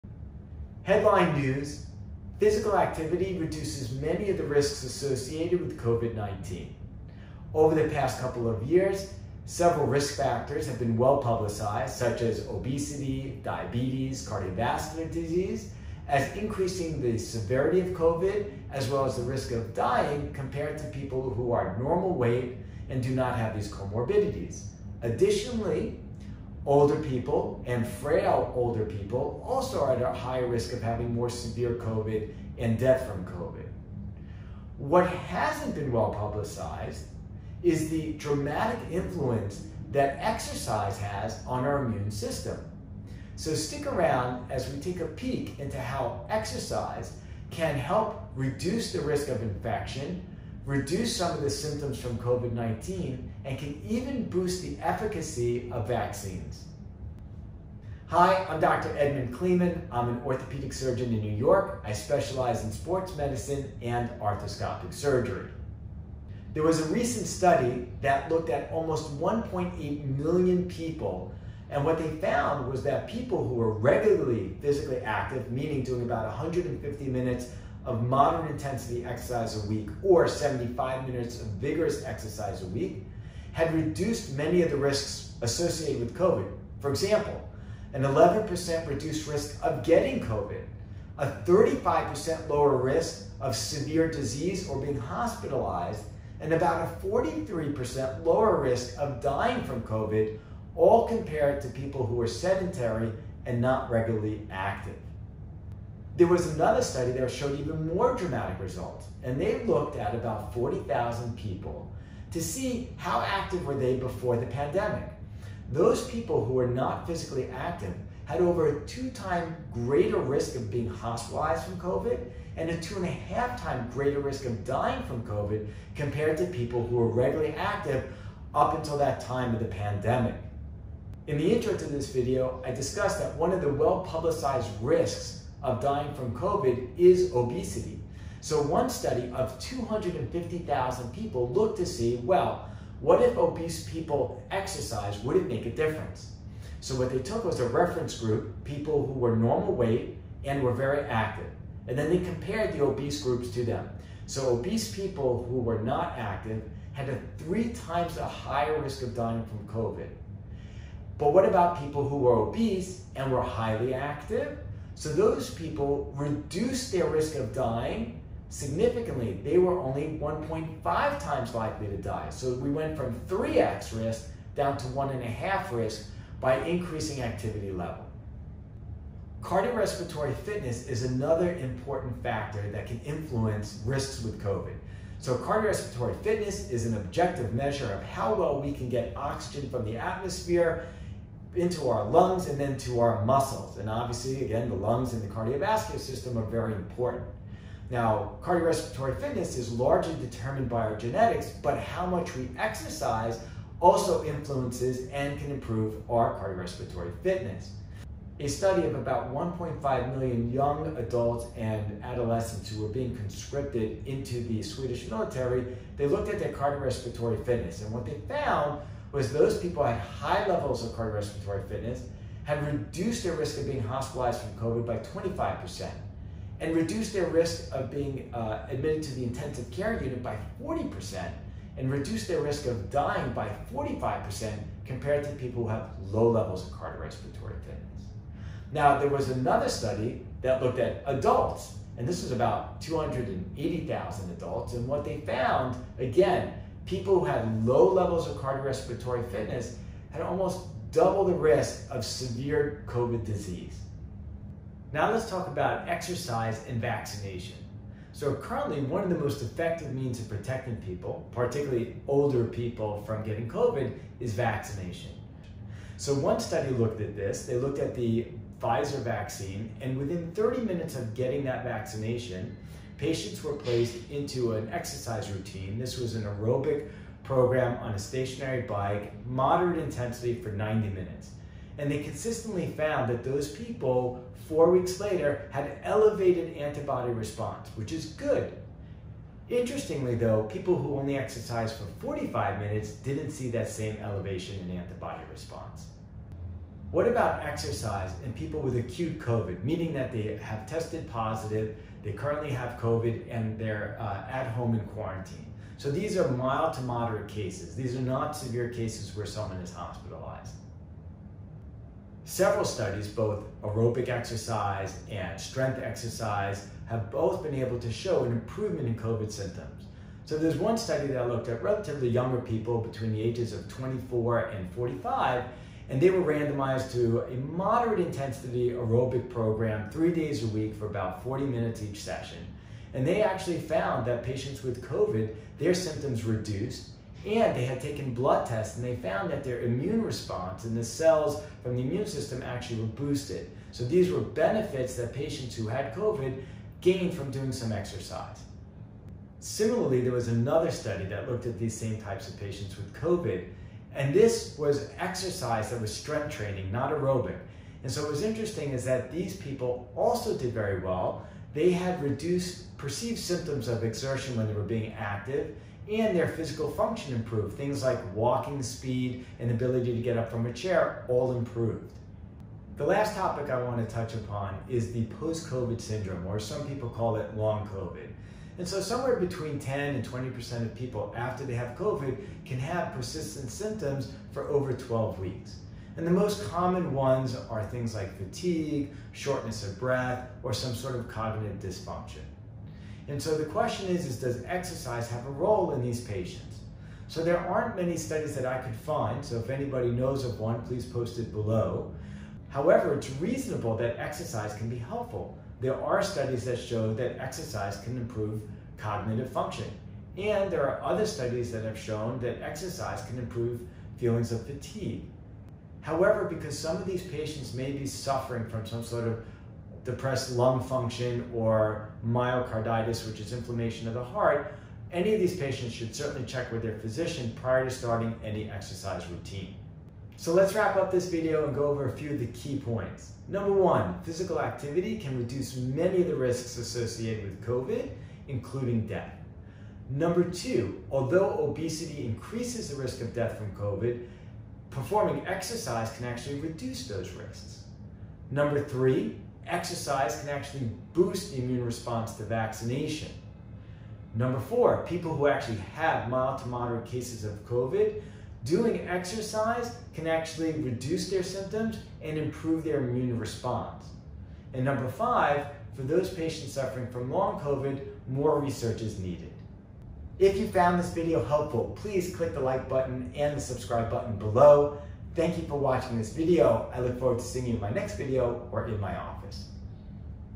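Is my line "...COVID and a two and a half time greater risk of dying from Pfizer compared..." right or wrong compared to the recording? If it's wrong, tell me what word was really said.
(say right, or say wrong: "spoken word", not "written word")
wrong: "COVID", not "Pfizer".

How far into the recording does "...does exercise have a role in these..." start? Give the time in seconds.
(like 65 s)
394 s.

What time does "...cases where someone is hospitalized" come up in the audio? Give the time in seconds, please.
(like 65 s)
308 s.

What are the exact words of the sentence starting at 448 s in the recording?
Number three, exercise can actually boost the immune response to vaccination.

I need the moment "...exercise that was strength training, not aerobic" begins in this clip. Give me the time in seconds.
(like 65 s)
354 s.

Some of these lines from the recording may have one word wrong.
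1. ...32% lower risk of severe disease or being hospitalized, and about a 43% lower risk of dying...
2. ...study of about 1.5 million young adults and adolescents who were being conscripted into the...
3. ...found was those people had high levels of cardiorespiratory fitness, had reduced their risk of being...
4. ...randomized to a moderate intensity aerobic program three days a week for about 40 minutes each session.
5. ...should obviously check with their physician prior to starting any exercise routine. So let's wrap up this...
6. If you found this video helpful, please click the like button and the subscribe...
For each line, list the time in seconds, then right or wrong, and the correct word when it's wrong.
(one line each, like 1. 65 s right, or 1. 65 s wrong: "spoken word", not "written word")
1. 91 s wrong: "35", not "32"
2. 208 s right
3. 218 s right
4. 326 s right
5. 425 s wrong: "certainly", not "obviously"
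6. 470 s right.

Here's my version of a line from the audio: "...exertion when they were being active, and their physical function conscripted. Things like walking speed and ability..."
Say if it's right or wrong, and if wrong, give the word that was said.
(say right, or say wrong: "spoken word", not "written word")
wrong: "improved", not "conscripted".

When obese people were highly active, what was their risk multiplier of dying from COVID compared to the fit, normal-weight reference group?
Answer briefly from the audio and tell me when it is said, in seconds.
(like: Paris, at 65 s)
1.5 times, at 170 s.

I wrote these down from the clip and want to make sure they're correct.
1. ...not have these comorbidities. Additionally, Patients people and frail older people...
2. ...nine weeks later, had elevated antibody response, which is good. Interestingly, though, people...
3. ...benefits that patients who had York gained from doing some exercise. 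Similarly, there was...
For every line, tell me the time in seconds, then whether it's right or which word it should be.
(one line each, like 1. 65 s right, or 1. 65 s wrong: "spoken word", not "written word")
1. 23 s wrong: "Older", not "Patients"
2. 284 s wrong: "four", not "nine"
3. 344 s wrong: "COVID", not "York".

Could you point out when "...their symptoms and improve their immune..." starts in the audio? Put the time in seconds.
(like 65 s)
461 s.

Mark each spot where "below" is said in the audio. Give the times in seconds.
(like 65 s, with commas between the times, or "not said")
401 s, 474 s.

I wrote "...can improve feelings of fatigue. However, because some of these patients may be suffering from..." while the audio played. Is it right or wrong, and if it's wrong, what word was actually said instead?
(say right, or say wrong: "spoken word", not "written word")
right.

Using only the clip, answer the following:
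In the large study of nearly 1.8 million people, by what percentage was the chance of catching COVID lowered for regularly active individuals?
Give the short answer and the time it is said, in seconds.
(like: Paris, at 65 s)
11%, at 88 s.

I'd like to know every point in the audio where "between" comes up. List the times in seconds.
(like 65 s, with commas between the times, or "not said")
322 s, 379 s.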